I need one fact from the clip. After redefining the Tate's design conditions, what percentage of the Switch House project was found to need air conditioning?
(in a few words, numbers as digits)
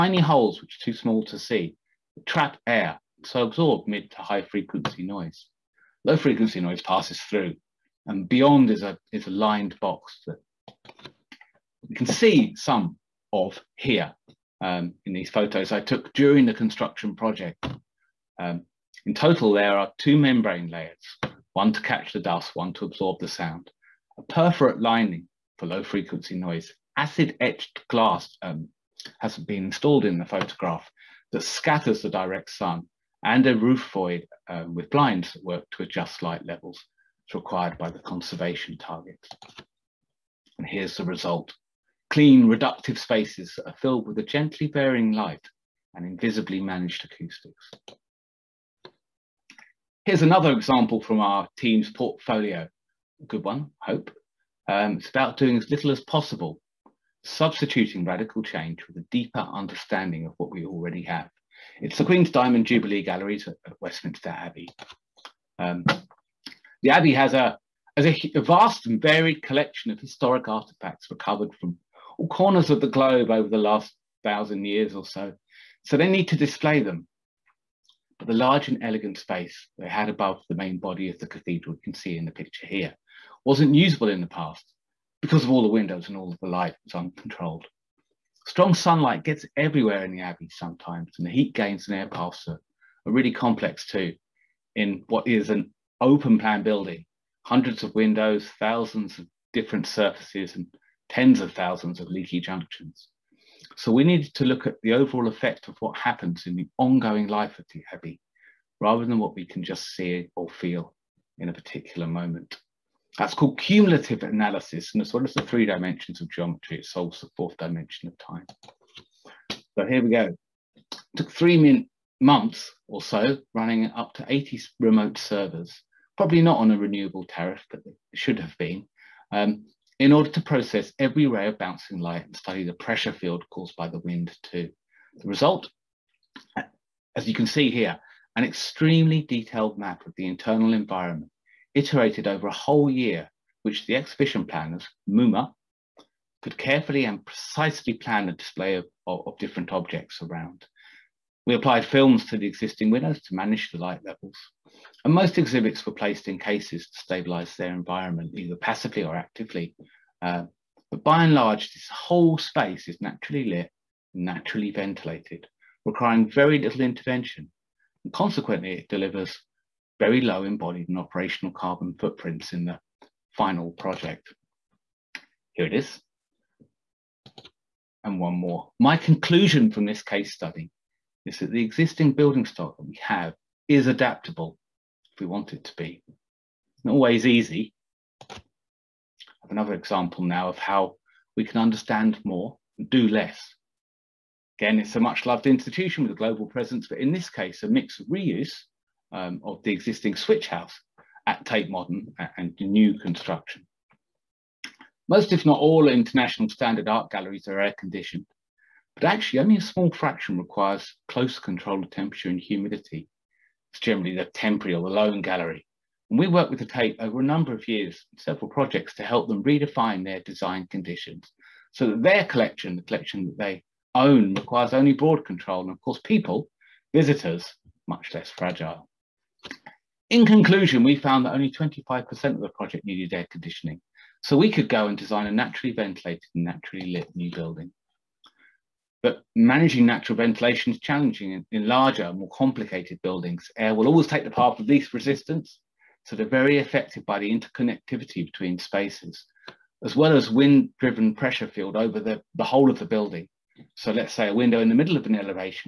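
25%.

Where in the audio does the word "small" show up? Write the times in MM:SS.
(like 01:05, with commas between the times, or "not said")
00:00, 03:29.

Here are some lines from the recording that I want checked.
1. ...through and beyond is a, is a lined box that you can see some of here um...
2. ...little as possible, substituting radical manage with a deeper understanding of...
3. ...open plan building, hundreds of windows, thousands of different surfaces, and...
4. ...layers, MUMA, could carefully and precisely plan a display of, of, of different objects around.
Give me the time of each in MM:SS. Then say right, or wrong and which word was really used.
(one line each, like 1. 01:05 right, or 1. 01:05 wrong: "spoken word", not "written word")
1. 00:07 right
2. 00:55 wrong: "change", not "manage"
3. 01:36 right
4. 02:24 wrong: "planners", not "layers".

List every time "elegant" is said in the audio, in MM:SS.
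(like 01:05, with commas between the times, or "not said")
01:18.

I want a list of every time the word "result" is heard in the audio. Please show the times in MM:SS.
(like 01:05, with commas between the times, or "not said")
00:41, 02:15.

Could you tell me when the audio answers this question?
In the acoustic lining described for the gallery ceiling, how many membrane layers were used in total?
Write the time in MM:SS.
00:19.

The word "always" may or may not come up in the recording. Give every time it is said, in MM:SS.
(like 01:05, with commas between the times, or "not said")
03:06, 04:03.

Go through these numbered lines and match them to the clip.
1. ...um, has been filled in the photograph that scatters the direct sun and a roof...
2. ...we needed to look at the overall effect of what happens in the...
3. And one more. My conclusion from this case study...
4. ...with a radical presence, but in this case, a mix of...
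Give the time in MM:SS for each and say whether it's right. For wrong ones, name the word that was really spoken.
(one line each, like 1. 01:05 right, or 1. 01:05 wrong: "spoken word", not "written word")
1. 00:28 wrong: "installed", not "filled"
2. 01:43 right
3. 02:58 right
4. 03:16 wrong: "global", not "radical".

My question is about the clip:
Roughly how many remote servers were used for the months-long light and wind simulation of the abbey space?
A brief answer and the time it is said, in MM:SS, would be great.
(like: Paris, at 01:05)
80, at 02:04.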